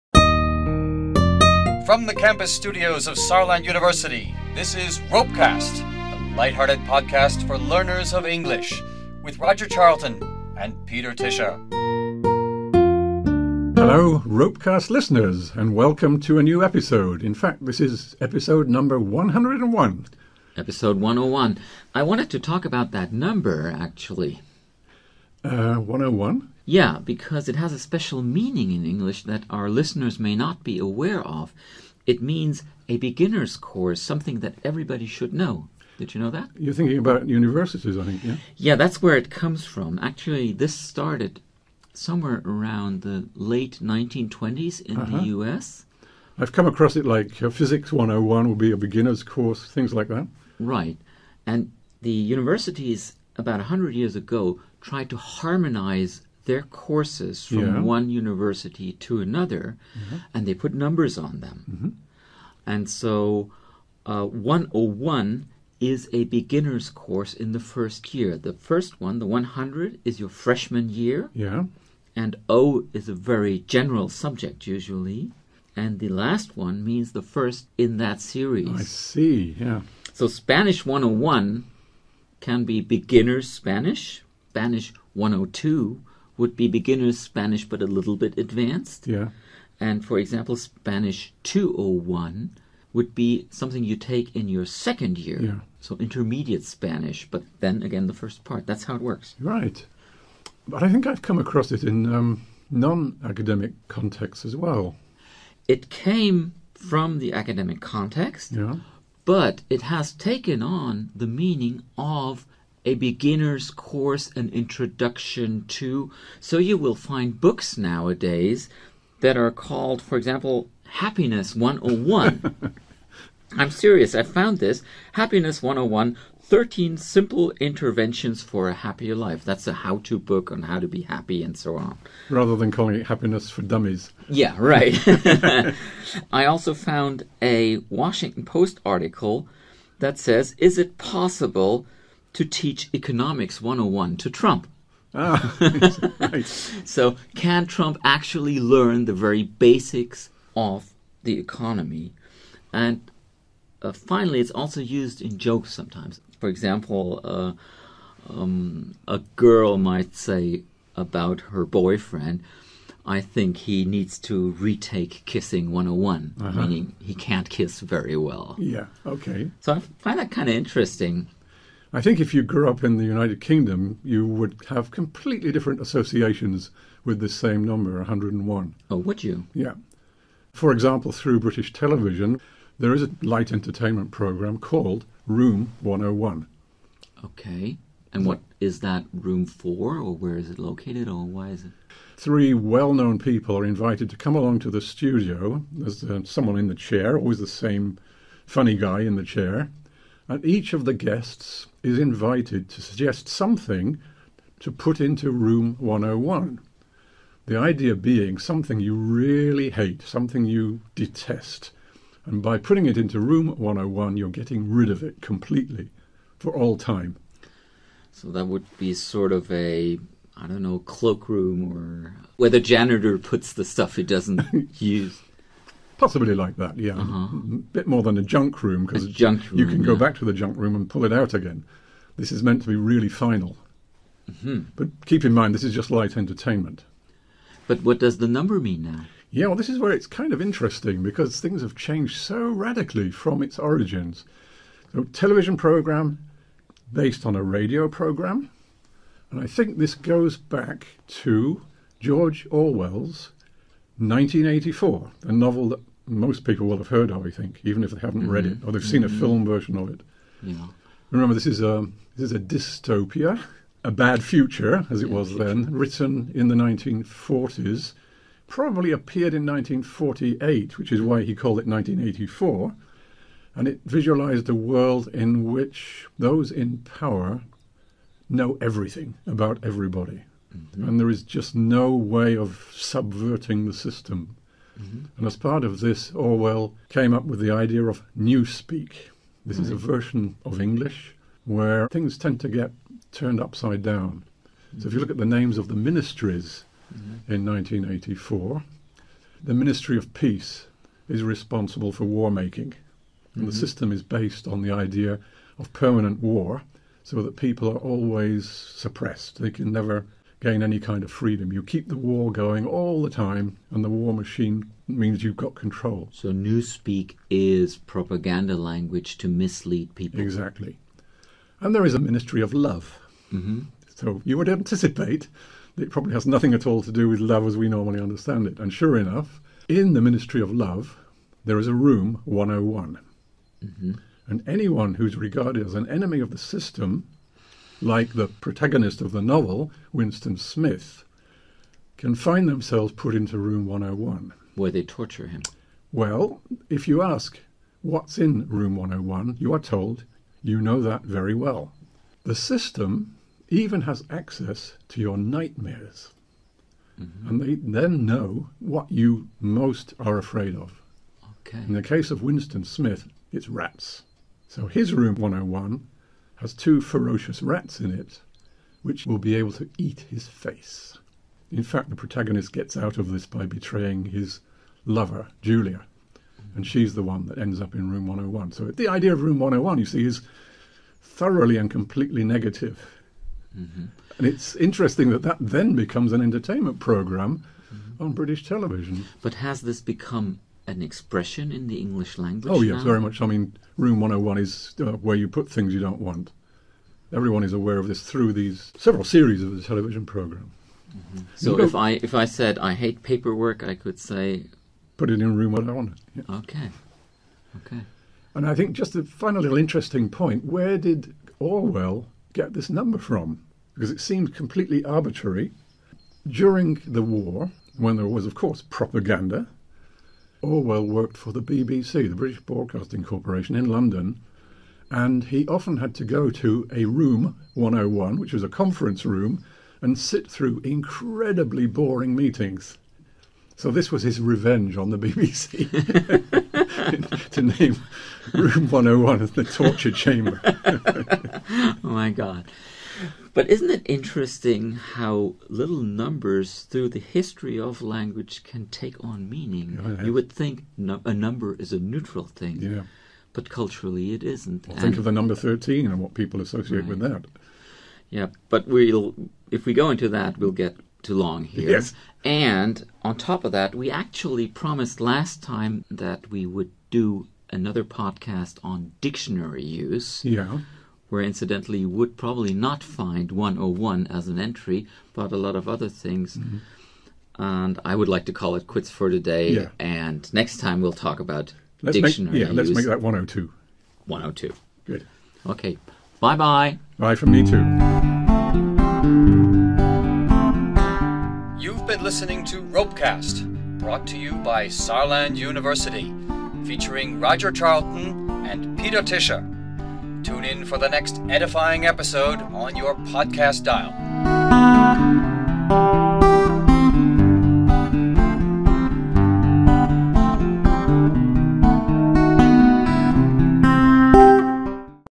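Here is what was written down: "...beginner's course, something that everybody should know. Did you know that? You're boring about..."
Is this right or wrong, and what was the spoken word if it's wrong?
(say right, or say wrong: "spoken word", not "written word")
wrong: "thinking", not "boring".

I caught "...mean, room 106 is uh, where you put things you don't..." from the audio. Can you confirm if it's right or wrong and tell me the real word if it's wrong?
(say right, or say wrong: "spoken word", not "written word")
wrong: "101", not "106".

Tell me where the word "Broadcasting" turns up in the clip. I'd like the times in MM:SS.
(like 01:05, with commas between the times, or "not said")
07:02.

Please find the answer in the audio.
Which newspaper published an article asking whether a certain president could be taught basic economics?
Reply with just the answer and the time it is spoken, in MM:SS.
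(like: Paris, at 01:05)
Washington Post, at 02:17.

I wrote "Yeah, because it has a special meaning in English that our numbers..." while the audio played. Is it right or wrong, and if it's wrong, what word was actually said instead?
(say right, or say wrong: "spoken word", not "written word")
wrong: "listeners", not "numbers".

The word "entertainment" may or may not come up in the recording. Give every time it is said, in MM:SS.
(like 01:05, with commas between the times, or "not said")
03:03, 03:56, 06:26.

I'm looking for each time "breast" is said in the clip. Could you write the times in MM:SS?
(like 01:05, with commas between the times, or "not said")
not said.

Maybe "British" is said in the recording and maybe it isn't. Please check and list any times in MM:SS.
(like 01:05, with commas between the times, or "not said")
03:01, 06:28, 07:02.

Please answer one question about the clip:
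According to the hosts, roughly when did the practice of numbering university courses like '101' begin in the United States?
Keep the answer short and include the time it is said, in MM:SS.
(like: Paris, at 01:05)
late 1920s, at 00:43.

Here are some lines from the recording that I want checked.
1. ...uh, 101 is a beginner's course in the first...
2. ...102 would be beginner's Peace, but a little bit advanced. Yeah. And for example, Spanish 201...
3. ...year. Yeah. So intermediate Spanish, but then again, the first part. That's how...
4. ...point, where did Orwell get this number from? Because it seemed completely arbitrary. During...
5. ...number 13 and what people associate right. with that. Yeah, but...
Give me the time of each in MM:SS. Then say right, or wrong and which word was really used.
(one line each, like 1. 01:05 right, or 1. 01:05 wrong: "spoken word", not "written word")
1. 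01:04 right
2. 01:25 wrong: "Spanish", not "Peace"
3. 01:35 right
4. 06:50 right
5. 07:35 right.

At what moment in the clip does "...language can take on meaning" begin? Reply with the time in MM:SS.
07:27.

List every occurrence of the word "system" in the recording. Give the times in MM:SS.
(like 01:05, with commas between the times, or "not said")
04:43, 05:03, 05:36, 05:52.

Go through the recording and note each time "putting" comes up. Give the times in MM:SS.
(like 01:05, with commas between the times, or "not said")
03:32.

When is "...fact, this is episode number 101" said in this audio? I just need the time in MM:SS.
00:17.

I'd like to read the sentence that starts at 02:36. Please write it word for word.
For example, uh, um, a girl might say about her boyfriend, I think he needs to retake kissing 101, uh-huh.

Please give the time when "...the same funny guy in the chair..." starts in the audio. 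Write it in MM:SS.
03:17.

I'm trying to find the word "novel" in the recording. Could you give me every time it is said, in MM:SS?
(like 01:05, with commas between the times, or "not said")
04:15, 05:39.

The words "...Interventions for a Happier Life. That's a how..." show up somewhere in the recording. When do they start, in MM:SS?
02:07.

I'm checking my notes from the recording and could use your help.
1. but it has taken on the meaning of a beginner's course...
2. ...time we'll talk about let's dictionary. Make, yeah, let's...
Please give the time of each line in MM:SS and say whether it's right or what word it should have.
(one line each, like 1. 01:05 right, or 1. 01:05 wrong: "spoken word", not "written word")
1. 01:49 right
2. 08:00 right.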